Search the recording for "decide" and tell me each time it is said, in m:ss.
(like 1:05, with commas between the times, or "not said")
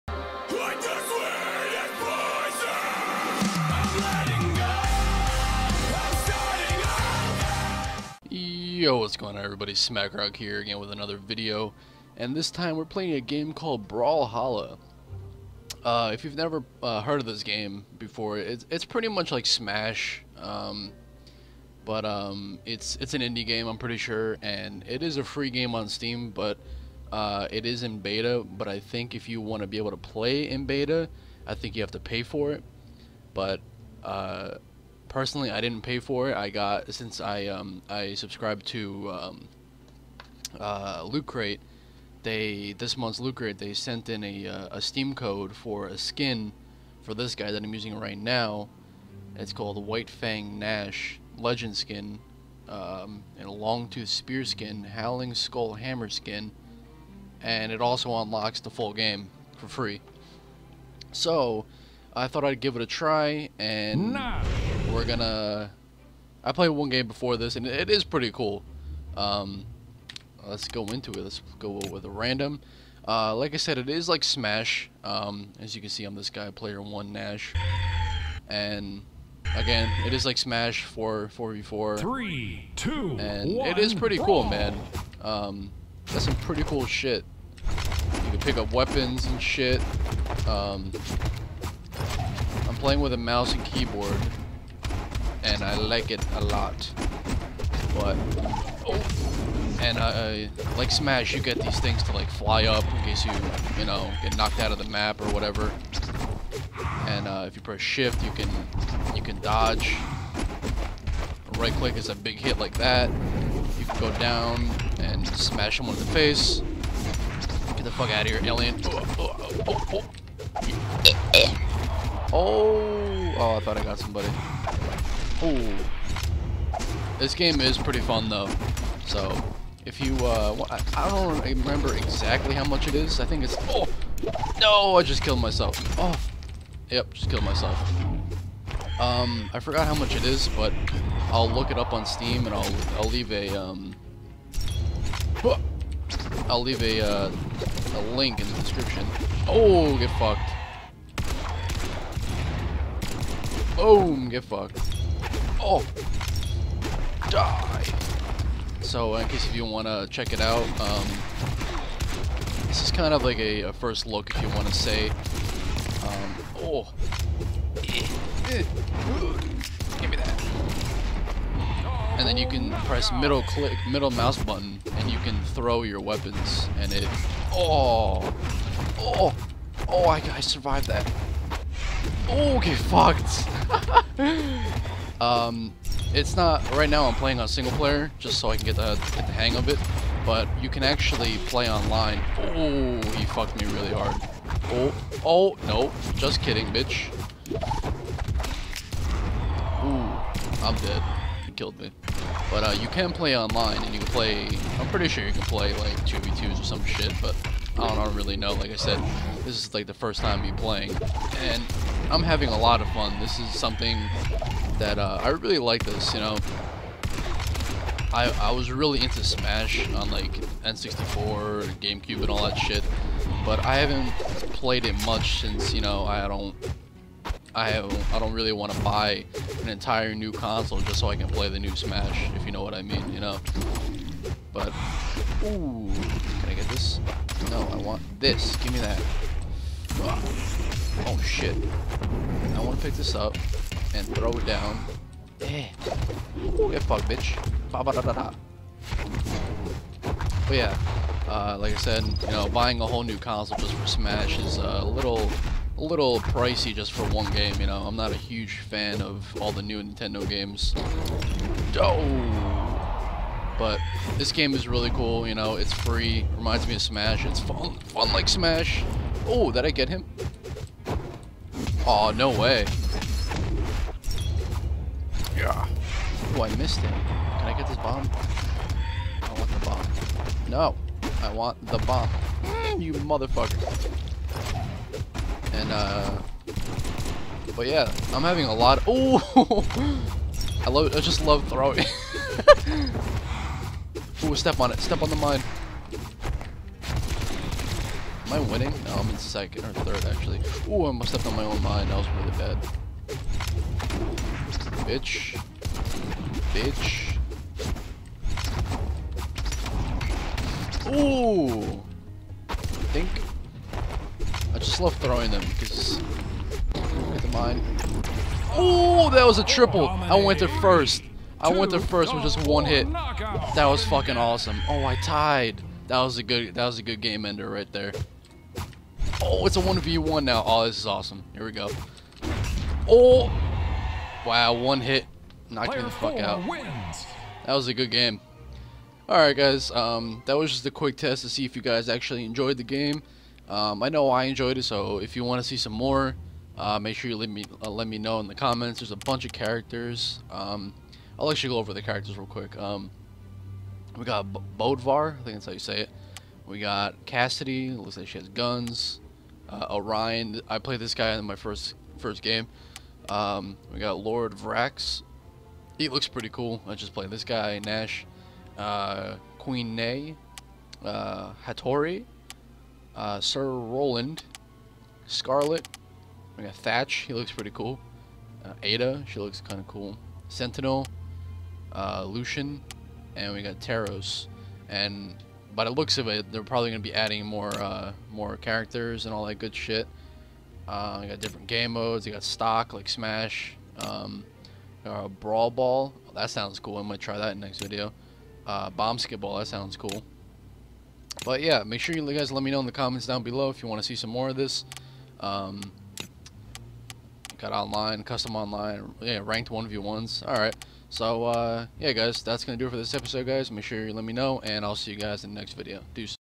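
not said.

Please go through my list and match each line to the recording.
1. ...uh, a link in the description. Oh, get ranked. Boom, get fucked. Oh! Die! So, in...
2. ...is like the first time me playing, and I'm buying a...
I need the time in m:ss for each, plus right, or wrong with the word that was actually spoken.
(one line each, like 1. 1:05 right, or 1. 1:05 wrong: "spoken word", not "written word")
1. 2:27 wrong: "fucked", not "ranked"
2. 3:29 wrong: "having", not "buying".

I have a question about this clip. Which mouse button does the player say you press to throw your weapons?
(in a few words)
Middle mouse button.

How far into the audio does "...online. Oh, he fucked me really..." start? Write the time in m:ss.
3:11.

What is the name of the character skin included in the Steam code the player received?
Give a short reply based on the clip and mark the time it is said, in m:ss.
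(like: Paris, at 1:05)
White Fang Gnash, at 0:49.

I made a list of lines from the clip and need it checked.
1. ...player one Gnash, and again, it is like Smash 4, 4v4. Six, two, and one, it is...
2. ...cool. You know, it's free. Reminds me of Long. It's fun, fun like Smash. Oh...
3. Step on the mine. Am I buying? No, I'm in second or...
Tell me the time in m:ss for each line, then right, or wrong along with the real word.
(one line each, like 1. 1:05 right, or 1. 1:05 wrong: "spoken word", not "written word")
1. 1:16 wrong: "Three", not "Six"
2. 4:24 wrong: "Smash", not "Long"
3. 4:54 wrong: "winning", not "buying".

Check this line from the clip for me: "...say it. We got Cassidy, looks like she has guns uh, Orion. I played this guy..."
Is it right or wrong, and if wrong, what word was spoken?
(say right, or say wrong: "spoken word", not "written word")
right.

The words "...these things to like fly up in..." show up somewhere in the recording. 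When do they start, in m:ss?
1:41.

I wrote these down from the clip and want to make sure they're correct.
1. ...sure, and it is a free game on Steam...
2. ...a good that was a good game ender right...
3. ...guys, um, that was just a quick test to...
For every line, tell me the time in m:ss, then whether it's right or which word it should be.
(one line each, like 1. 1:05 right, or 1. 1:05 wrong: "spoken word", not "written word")
1. 0:23 right
2. 5:26 right
3. 5:39 right.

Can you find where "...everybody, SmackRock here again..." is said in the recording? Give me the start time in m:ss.
0:09.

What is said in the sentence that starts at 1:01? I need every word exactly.
So, I thought I'd give it a try, and...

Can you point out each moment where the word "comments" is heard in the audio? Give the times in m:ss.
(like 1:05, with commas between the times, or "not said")
5:48, 6:42.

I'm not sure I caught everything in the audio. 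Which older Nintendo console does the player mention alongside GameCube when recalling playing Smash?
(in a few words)
N64.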